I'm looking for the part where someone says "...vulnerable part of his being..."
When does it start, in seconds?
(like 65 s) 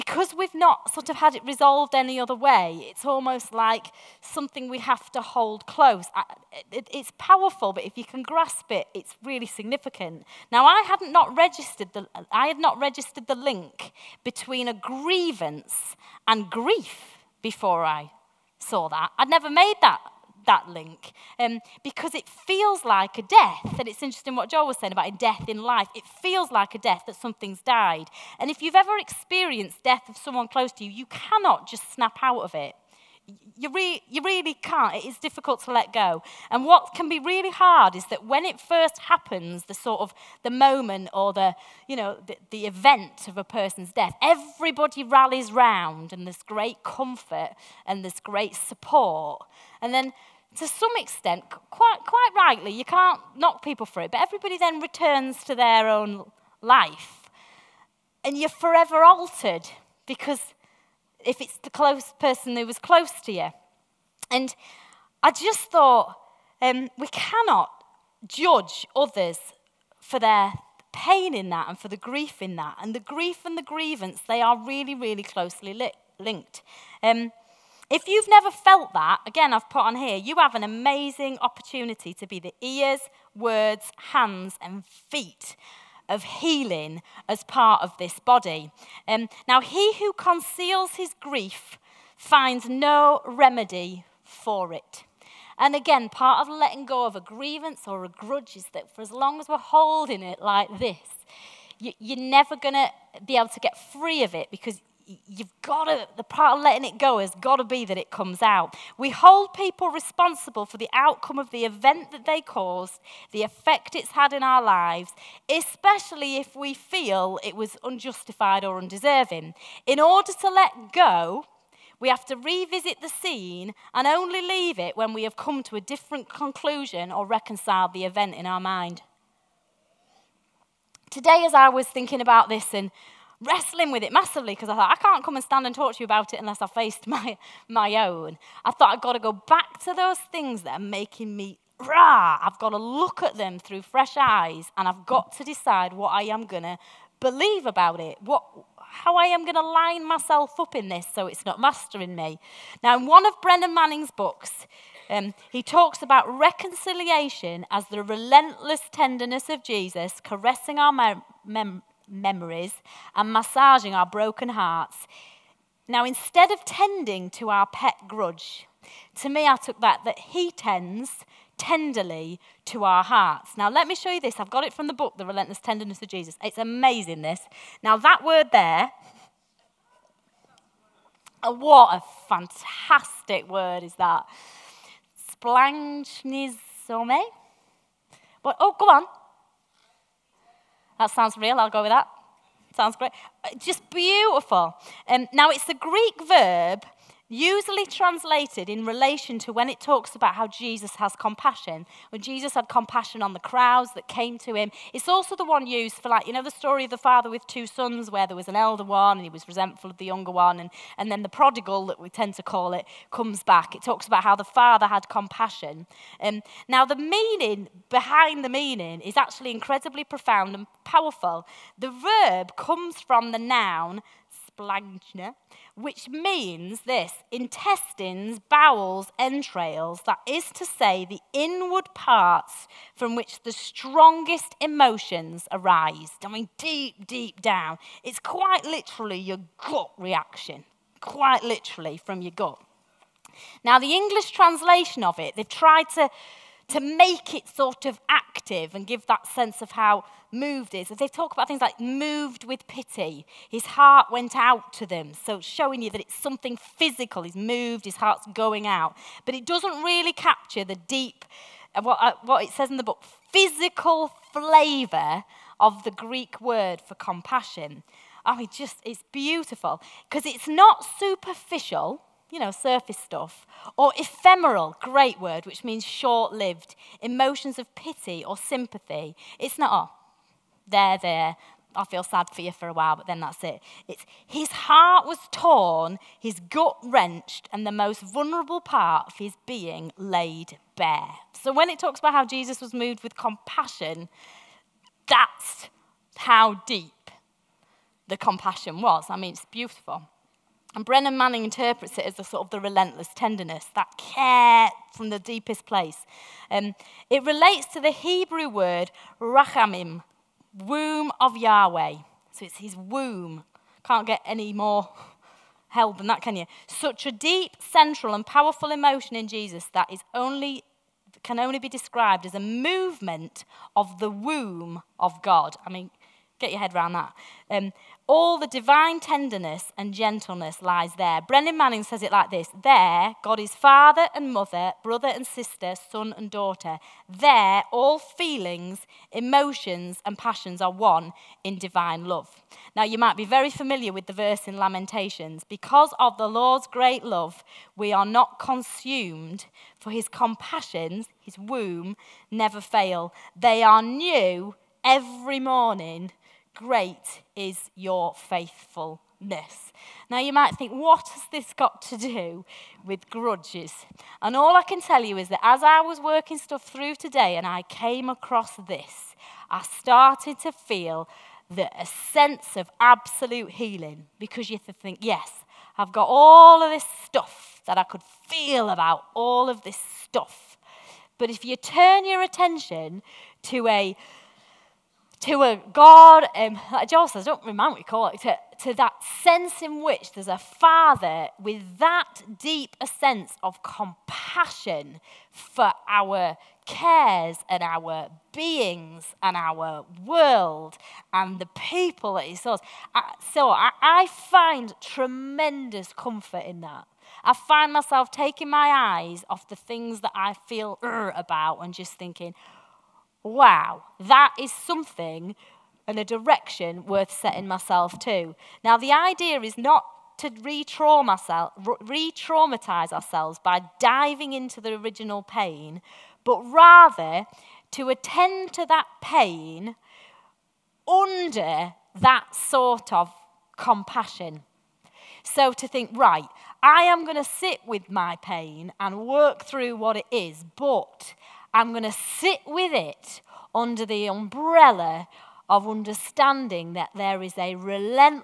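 288 s.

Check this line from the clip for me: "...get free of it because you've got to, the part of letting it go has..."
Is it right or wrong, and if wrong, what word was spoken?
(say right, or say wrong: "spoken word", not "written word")
right.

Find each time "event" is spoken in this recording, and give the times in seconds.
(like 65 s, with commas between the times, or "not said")
42 s, 111 s, 128 s.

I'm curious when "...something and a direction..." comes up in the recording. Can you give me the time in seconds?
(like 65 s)
414 s.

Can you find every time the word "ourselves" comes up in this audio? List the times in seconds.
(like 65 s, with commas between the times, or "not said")
422 s.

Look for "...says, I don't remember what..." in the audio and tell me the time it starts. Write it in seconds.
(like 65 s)
387 s.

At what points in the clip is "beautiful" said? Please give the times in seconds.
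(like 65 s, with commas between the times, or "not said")
193 s, 269 s, 299 s.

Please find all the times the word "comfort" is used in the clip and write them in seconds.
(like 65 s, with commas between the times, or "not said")
46 s, 405 s.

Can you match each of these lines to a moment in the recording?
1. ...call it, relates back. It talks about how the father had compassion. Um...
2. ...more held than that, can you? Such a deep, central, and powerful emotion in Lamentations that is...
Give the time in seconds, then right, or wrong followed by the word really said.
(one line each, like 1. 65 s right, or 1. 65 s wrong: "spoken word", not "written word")
1. 212 s wrong: "comes", not "relates"
2. 314 s wrong: "Jesus", not "Lamentations".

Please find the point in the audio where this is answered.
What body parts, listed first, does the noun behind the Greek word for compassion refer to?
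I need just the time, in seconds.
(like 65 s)
227 s.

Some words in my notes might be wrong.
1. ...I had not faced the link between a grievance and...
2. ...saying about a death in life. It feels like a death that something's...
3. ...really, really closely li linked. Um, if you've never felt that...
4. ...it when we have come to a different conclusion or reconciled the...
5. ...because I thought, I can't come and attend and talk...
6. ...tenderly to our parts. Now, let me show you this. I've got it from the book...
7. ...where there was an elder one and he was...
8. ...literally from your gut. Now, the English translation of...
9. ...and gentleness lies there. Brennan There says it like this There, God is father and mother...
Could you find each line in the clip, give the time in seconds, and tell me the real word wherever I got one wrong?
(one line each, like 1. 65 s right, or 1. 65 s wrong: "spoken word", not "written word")
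1. 12 s wrong: "registered", not "faced"
2. 24 s right
3. 74 s right
4. 124 s right
5. 134 s wrong: "stand", not "attend"
6. 171 s wrong: "hearts", not "parts"
7. 208 s right
8. 241 s right
9. 329 s wrong: "Manning", not "There".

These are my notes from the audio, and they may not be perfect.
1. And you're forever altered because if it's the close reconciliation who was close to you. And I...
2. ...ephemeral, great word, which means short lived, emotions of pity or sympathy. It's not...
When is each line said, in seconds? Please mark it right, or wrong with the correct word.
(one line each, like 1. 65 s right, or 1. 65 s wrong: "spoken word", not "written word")
1. 58 s wrong: "person", not "reconciliation"
2. 273 s right.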